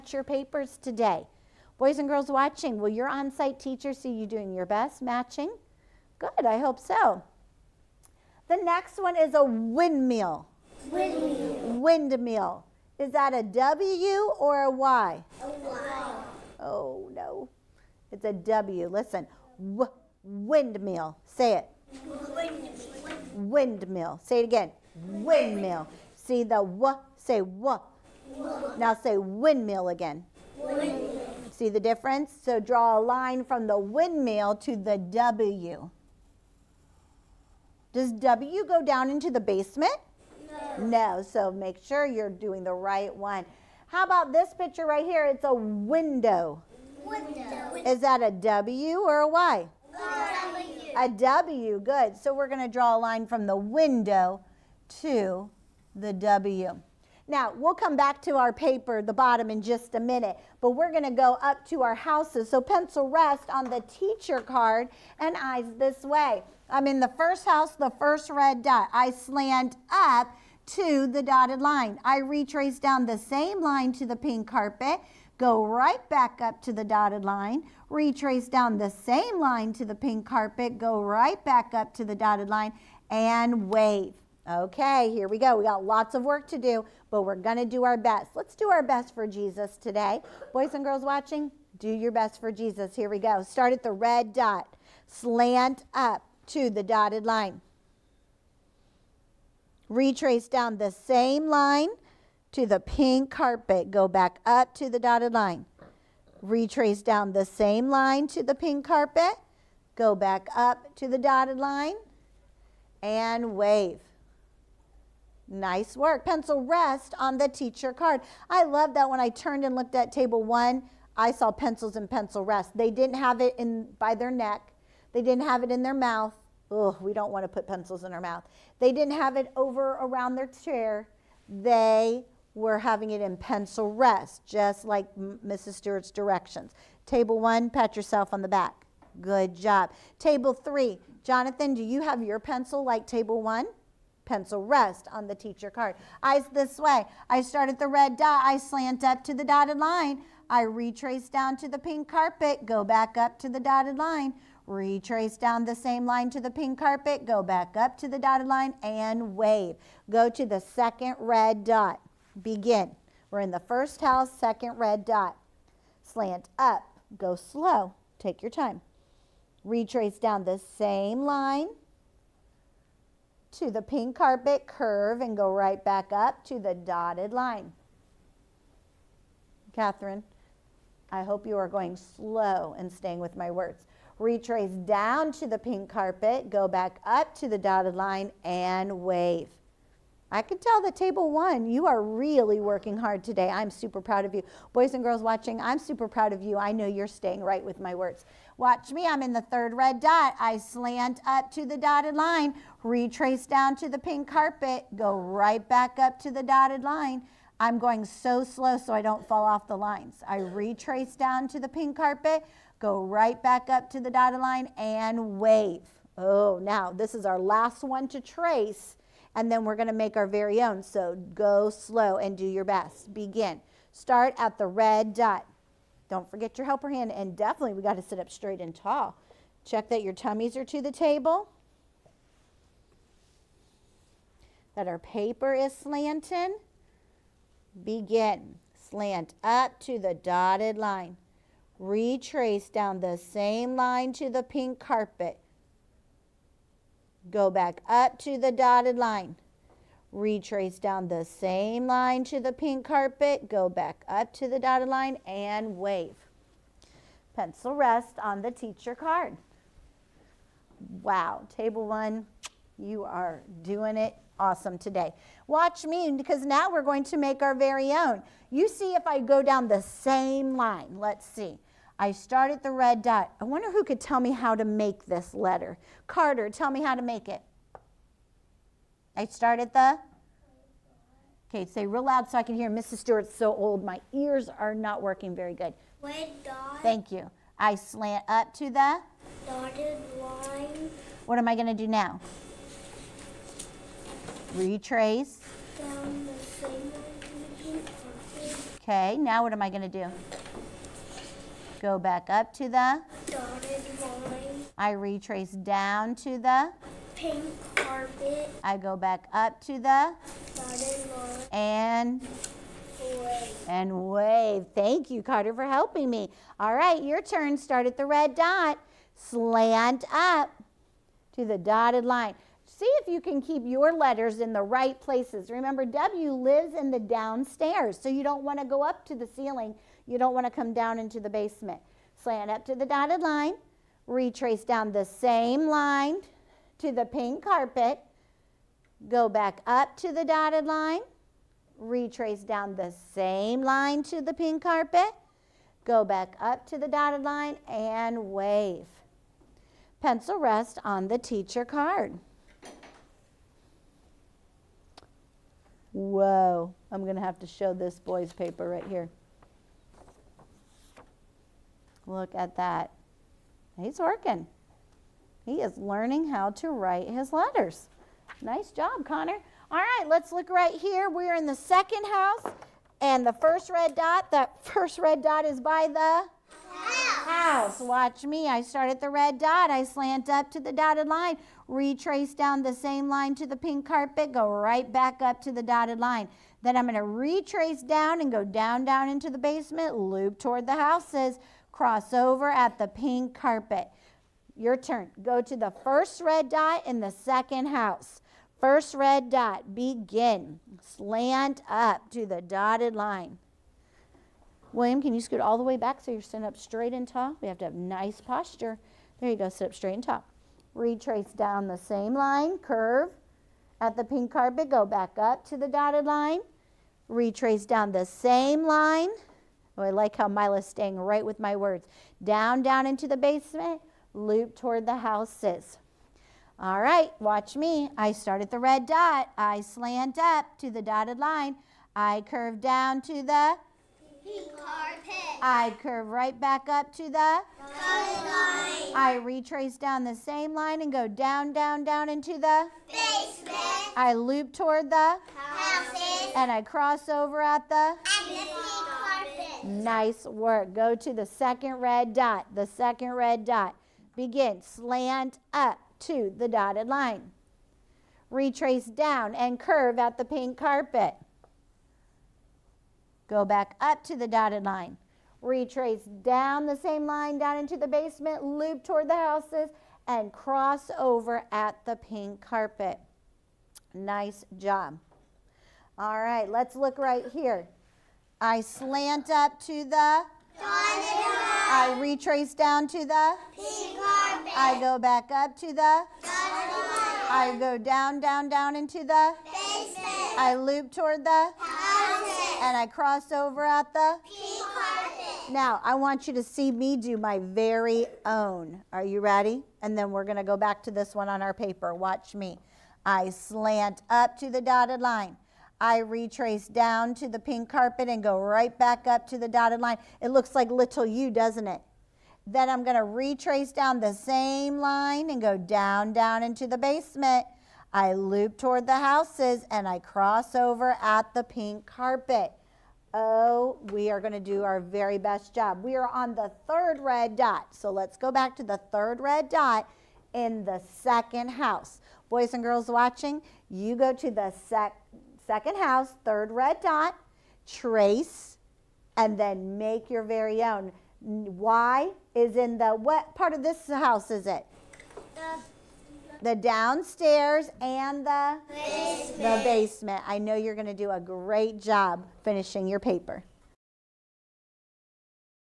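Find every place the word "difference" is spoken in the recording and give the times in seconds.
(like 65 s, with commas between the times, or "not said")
31 s.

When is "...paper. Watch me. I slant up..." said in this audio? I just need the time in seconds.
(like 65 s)
501 s.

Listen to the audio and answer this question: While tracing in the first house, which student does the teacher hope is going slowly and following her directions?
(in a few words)
Catherine.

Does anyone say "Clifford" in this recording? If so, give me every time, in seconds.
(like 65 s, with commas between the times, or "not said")
not said.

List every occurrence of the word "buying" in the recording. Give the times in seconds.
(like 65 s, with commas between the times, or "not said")
not said.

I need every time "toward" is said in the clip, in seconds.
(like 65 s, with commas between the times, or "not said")
390 s, 424 s, 444 s, 468 s, 490 s, 518 s.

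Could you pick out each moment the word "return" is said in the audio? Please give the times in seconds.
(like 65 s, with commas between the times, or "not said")
not said.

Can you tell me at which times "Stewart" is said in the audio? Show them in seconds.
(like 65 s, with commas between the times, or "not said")
135 s, 282 s.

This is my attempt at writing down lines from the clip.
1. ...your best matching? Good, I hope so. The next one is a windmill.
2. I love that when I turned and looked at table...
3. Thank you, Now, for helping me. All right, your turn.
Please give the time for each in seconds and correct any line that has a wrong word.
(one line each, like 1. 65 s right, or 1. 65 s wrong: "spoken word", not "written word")
1. 4 s right
2. 118 s right
3. 314 s wrong: "Carter", not "Now".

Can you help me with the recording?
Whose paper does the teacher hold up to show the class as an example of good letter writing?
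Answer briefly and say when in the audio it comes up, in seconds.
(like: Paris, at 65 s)
Connor, at 368 s.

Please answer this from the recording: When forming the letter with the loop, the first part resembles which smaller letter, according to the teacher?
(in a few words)
little u.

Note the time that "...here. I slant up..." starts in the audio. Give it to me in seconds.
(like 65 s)
477 s.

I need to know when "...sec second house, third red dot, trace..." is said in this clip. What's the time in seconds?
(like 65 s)
534 s.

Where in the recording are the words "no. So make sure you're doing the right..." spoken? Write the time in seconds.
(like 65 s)
41 s.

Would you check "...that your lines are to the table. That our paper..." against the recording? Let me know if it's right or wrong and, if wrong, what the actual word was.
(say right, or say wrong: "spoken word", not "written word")
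wrong: "tummies", not "lines".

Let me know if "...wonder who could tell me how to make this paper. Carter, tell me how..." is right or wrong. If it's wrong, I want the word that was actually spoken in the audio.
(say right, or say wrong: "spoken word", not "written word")
wrong: "letter", not "paper".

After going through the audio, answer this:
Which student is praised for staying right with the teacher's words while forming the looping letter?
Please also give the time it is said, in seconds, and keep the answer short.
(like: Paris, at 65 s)
Mila, at 420 s.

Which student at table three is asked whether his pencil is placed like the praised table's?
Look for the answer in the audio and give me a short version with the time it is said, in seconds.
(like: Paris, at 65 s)
Jonathan, at 140 s.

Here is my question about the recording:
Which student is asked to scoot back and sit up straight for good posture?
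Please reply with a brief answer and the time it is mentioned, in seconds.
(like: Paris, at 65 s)
William, at 404 s.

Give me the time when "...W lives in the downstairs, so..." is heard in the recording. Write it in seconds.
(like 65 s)
325 s.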